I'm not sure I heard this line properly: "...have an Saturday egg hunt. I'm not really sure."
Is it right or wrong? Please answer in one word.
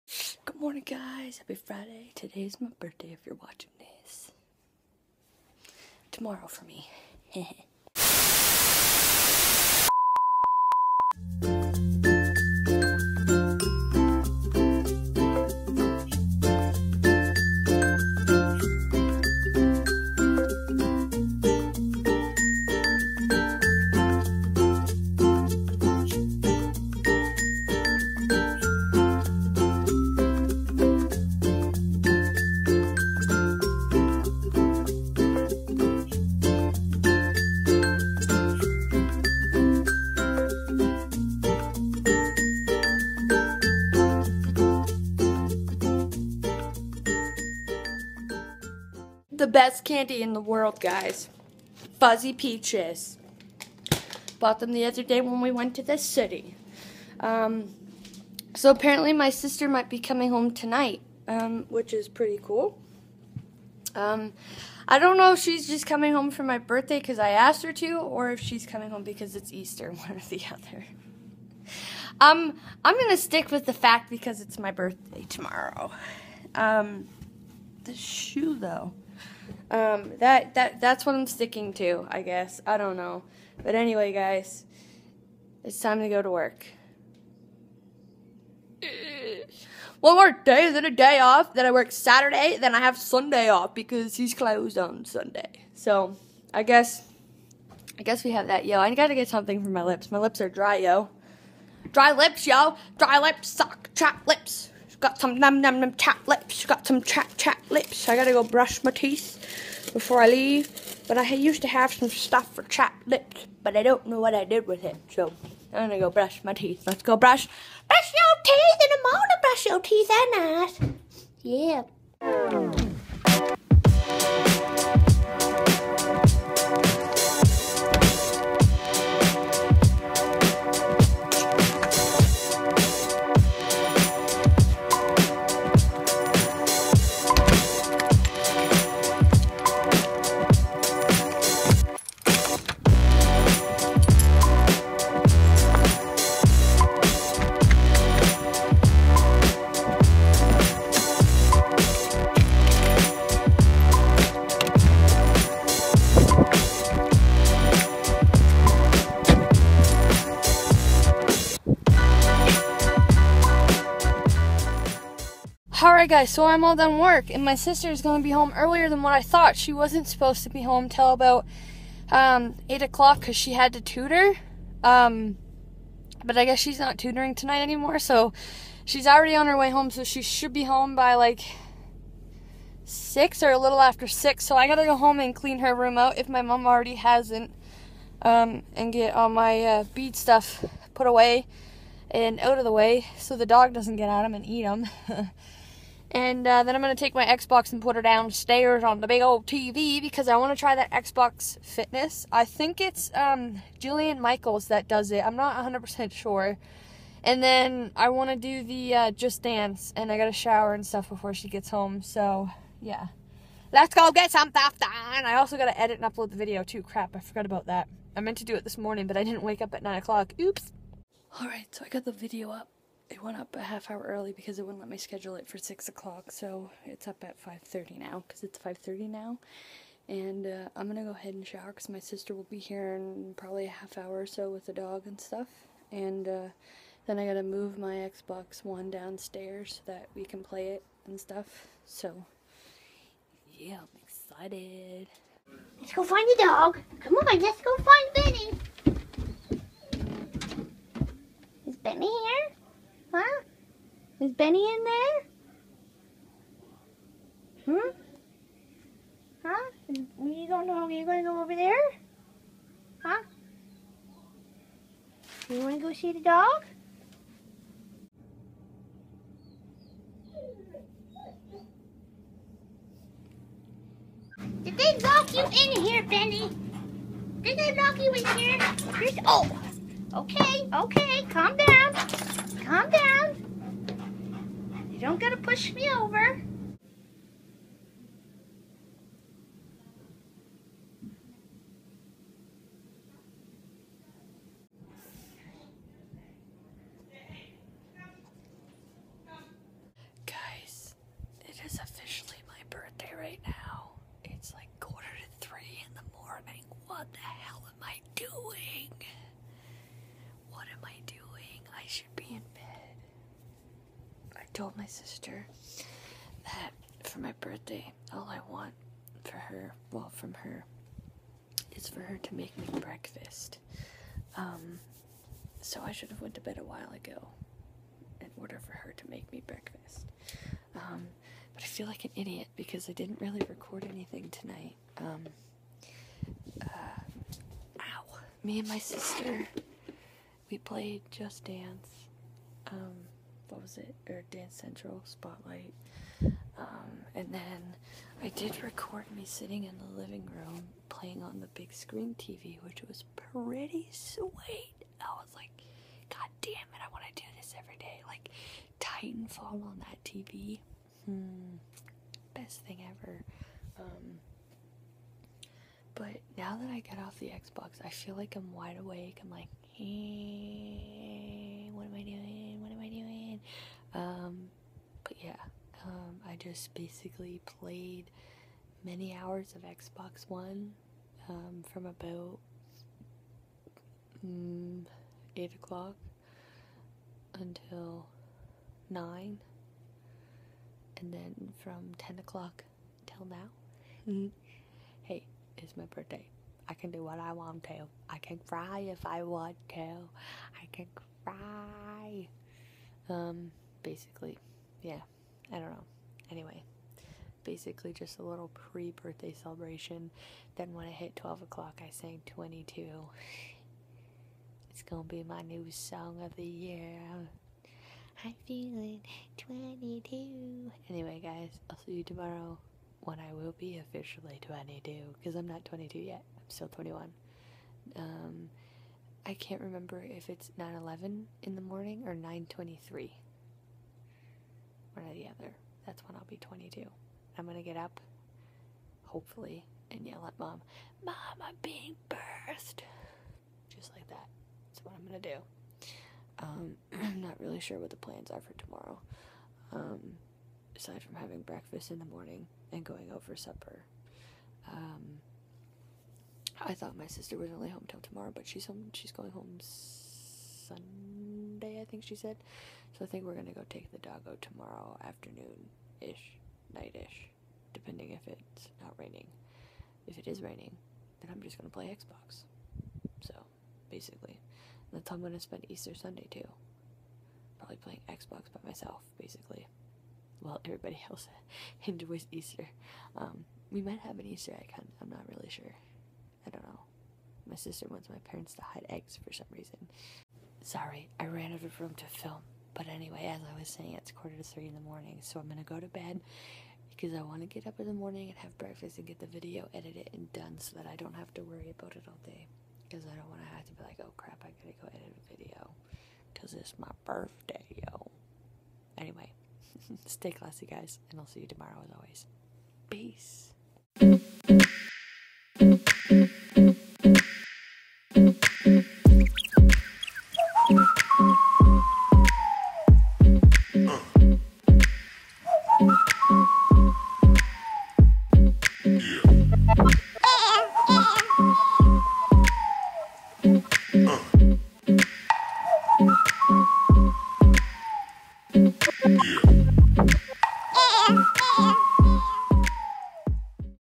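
wrong.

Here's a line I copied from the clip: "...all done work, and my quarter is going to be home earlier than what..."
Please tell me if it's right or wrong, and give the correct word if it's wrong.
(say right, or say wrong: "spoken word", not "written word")
wrong: "sister", not "quarter".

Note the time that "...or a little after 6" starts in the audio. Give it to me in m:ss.
3:03.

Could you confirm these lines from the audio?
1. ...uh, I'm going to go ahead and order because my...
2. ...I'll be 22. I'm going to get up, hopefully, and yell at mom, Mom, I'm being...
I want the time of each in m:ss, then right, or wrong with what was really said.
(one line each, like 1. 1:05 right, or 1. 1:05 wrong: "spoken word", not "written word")
1. 3:50 wrong: "shower", not "order"
2. 7:16 right.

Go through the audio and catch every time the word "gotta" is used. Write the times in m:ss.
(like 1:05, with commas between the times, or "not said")
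1:38, 1:48, 4:45, 8:24.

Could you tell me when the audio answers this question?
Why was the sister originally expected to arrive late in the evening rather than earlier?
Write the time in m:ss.
2:53.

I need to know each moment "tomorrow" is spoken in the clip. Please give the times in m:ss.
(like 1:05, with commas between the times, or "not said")
0:06, 1:15, 7:02, 7:28, 7:38, 7:44, 8:31.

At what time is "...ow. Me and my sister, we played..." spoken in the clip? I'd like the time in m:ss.
5:37.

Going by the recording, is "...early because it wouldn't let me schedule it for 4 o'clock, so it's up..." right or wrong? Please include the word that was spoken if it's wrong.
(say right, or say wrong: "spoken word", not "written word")
wrong: "6", not "4".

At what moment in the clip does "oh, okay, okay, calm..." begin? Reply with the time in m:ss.
4:39.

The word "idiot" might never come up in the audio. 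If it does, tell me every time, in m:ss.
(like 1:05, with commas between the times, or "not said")
5:32.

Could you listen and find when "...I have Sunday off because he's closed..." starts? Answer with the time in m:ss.
1:32.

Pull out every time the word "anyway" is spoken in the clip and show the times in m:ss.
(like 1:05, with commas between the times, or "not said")
1:23, 6:46, 7:00, 8:12, 8:28.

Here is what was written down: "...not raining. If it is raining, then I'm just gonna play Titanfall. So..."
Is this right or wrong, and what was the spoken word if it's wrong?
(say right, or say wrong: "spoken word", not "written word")
wrong: "Xbox", not "Titanfall".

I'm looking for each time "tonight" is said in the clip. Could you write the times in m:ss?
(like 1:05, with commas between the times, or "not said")
1:00, 2:57, 5:34.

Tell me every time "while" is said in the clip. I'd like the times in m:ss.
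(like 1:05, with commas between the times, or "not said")
5:26, 8:00.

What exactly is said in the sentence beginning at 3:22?
I think it's um, Jillian Michaels that does it.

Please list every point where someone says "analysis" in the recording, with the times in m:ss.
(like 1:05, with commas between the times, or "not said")
not said.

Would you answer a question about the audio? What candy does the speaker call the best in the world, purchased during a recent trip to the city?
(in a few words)
Fuzzy peaches.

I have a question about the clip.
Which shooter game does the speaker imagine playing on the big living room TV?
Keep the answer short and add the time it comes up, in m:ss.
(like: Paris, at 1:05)
Titanfall, at 5:58.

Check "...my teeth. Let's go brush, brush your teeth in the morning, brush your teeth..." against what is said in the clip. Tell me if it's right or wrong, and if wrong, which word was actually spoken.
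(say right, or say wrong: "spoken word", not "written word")
right.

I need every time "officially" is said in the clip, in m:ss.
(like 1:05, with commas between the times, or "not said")
5:01, 7:03.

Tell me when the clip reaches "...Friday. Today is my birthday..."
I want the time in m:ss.
0:01.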